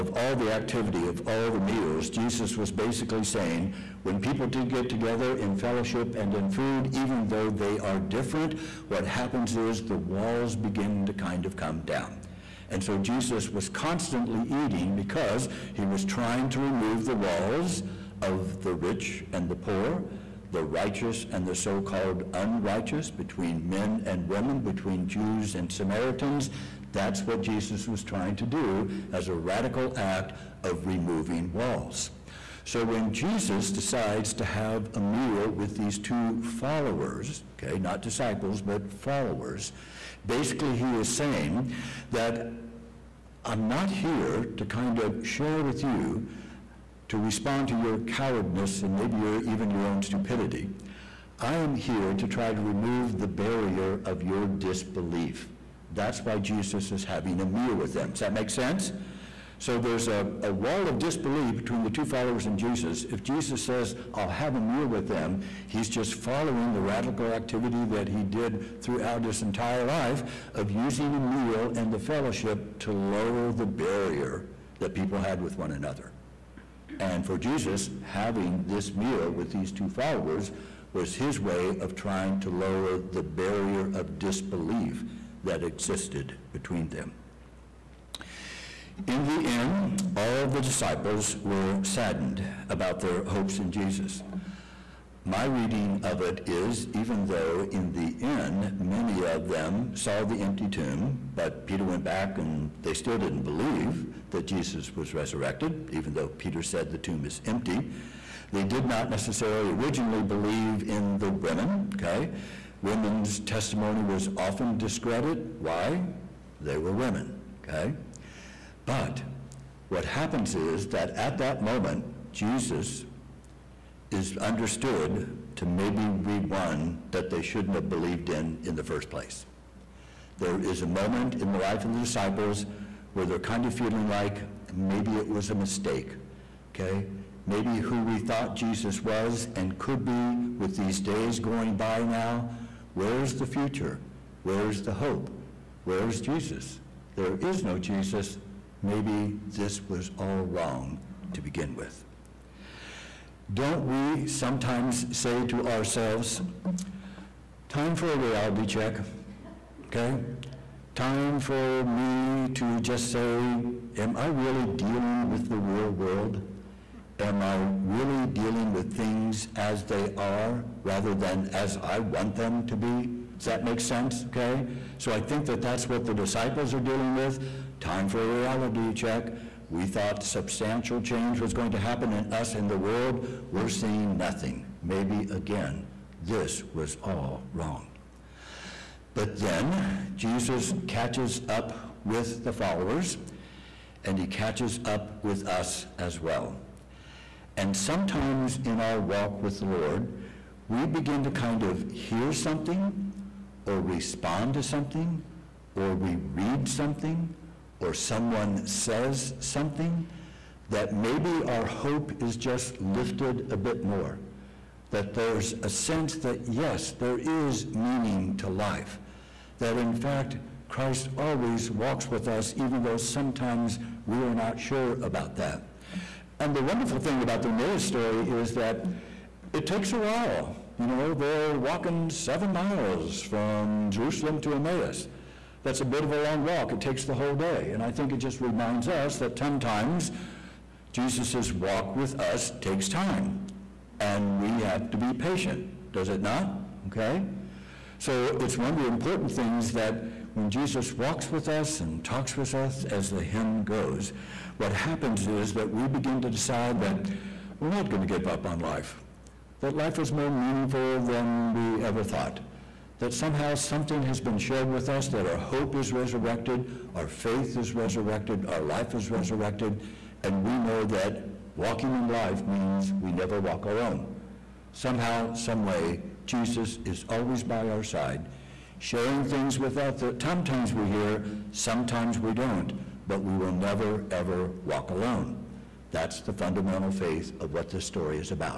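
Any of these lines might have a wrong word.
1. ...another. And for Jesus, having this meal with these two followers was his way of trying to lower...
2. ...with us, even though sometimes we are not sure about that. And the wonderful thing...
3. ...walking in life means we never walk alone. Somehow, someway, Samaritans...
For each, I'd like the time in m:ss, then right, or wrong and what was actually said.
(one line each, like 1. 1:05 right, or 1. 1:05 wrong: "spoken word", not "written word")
1. 1:15 right
2. 3:42 right
3. 4:31 wrong: "Jesus", not "Samaritans".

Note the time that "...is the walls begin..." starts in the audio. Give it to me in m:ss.
0:09.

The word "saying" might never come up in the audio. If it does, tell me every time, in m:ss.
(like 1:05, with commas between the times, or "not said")
0:03, 0:41.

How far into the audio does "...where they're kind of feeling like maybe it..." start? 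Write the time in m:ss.
2:13.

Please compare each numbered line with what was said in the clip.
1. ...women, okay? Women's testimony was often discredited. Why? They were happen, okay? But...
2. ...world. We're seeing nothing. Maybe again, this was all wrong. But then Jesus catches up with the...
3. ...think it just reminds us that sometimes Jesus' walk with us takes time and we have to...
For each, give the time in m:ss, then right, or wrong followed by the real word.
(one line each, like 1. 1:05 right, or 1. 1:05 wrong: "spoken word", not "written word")
1. 1:51 wrong: "women", not "happen"
2. 3:02 right
3. 3:57 right.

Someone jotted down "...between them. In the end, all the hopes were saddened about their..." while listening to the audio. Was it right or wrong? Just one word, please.
wrong.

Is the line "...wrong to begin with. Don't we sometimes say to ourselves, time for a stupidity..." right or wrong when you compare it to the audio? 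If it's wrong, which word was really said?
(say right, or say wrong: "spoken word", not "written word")
wrong: "reality", not "stupidity".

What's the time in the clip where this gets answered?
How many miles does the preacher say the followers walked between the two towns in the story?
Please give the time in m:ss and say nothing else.
3:52.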